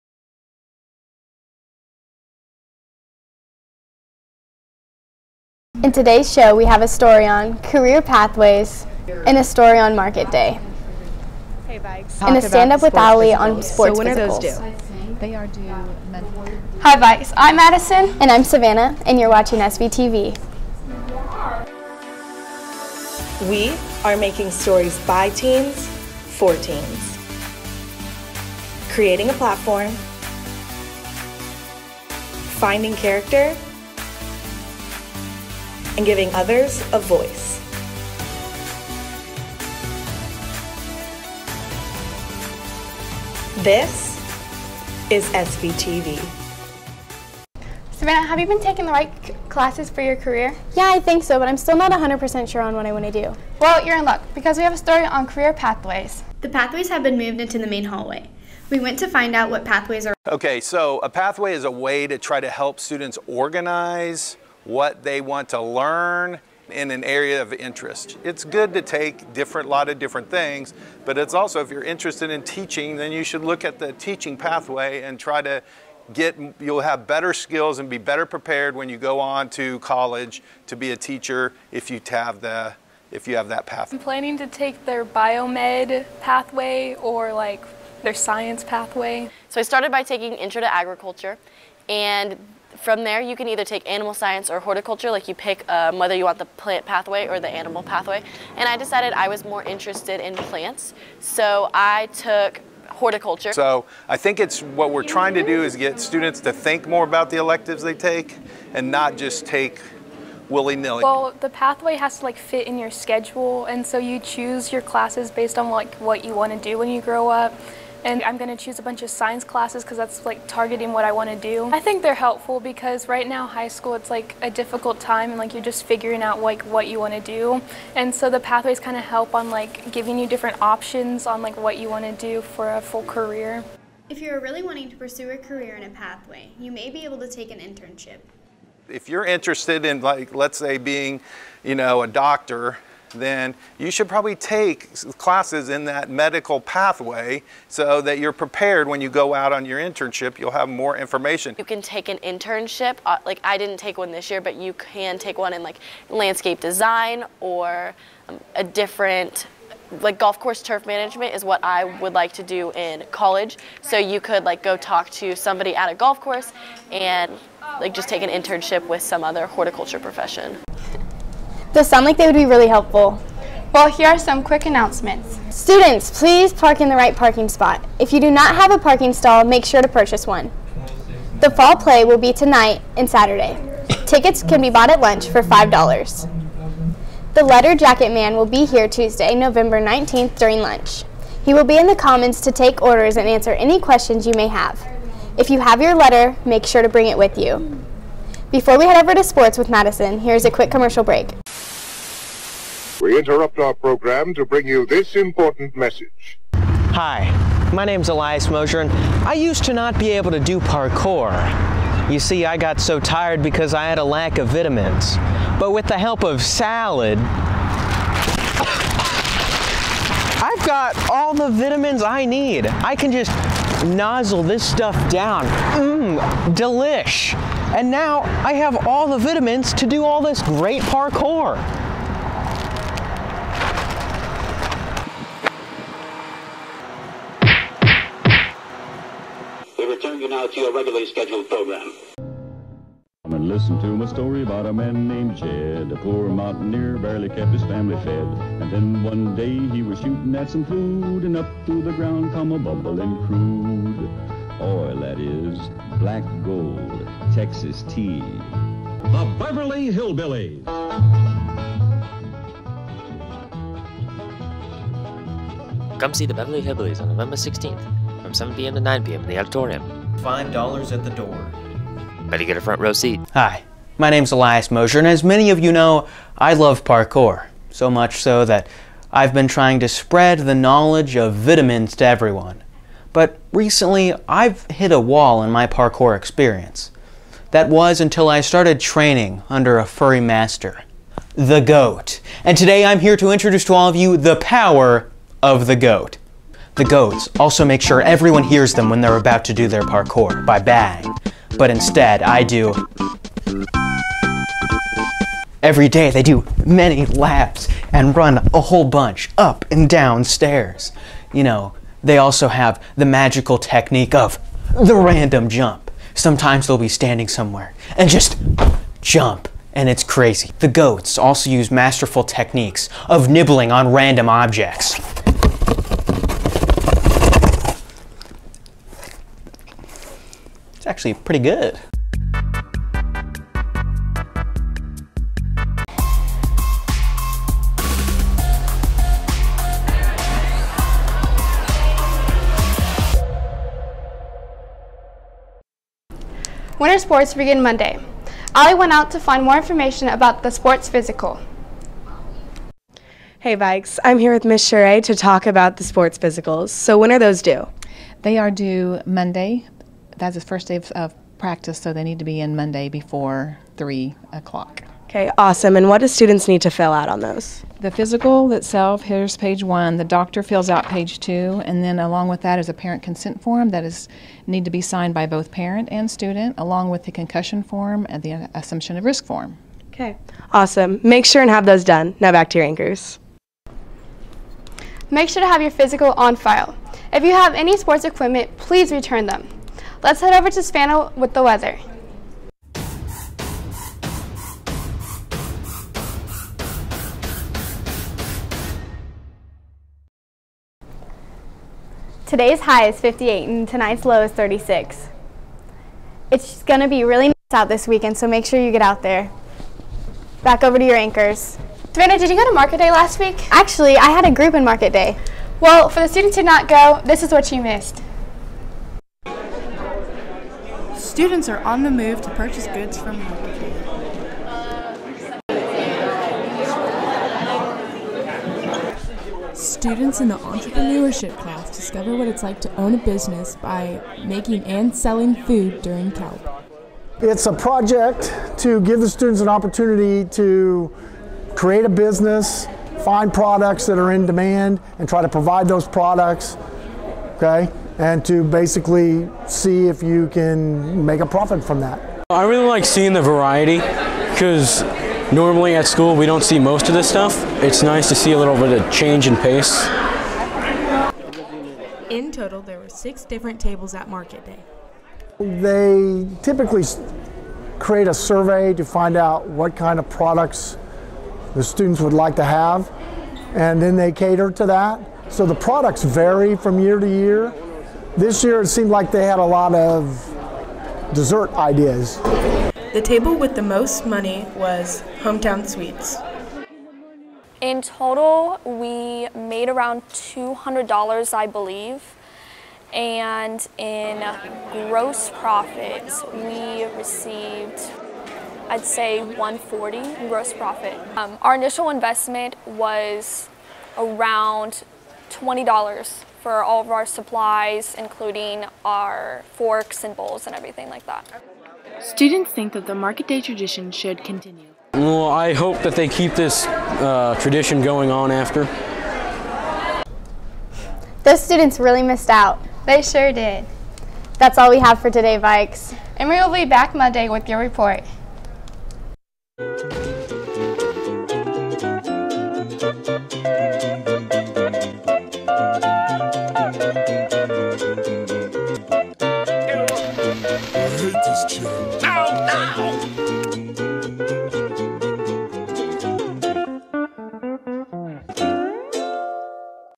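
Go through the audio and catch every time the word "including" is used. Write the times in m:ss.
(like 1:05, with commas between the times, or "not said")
8:27.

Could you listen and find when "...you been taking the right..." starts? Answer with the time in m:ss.
0:48.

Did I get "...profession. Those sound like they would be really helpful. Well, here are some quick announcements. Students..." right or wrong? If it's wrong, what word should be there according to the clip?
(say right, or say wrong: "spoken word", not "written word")
right.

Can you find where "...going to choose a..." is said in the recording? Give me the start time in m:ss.
1:58.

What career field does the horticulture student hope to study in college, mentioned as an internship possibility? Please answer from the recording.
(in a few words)
Golf course turf management.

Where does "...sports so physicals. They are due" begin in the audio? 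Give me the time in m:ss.
0:13.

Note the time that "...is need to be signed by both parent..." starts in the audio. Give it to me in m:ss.
6:13.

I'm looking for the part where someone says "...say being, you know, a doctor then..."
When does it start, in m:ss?
2:20.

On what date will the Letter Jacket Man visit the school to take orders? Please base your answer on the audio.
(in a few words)
Tuesday, November 19th.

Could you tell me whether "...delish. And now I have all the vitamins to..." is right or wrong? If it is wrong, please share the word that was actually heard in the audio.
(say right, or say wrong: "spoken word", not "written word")
right.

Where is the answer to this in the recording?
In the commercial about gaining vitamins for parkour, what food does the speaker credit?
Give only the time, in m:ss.
3:36.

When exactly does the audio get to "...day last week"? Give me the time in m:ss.
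6:52.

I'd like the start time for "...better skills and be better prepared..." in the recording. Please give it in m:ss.
1:17.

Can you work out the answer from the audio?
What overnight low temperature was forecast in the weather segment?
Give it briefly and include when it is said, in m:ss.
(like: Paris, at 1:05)
36, at 6:44.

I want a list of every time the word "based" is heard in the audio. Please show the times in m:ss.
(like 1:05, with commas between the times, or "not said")
1:55.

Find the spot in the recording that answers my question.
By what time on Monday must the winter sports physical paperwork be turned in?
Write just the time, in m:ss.
6:03.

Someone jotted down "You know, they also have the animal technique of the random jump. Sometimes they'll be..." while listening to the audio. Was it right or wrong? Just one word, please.
wrong.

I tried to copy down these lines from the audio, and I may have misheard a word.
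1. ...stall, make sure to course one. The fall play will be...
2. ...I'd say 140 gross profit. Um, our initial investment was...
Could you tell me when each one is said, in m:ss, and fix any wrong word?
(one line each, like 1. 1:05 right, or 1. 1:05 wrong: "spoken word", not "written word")
1. 2:59 wrong: "purchase", not "course"
2. 8:18 right.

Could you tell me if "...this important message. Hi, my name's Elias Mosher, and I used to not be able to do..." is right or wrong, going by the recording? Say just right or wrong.
right.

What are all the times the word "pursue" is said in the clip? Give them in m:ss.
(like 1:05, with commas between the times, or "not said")
2:14.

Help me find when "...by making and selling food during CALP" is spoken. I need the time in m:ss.
7:13.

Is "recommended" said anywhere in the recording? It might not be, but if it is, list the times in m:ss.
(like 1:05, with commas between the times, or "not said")
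not said.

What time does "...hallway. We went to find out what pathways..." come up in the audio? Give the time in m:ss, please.
0:57.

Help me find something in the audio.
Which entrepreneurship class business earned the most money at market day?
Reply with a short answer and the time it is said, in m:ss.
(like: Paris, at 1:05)
Hometown Sweets, at 8:05.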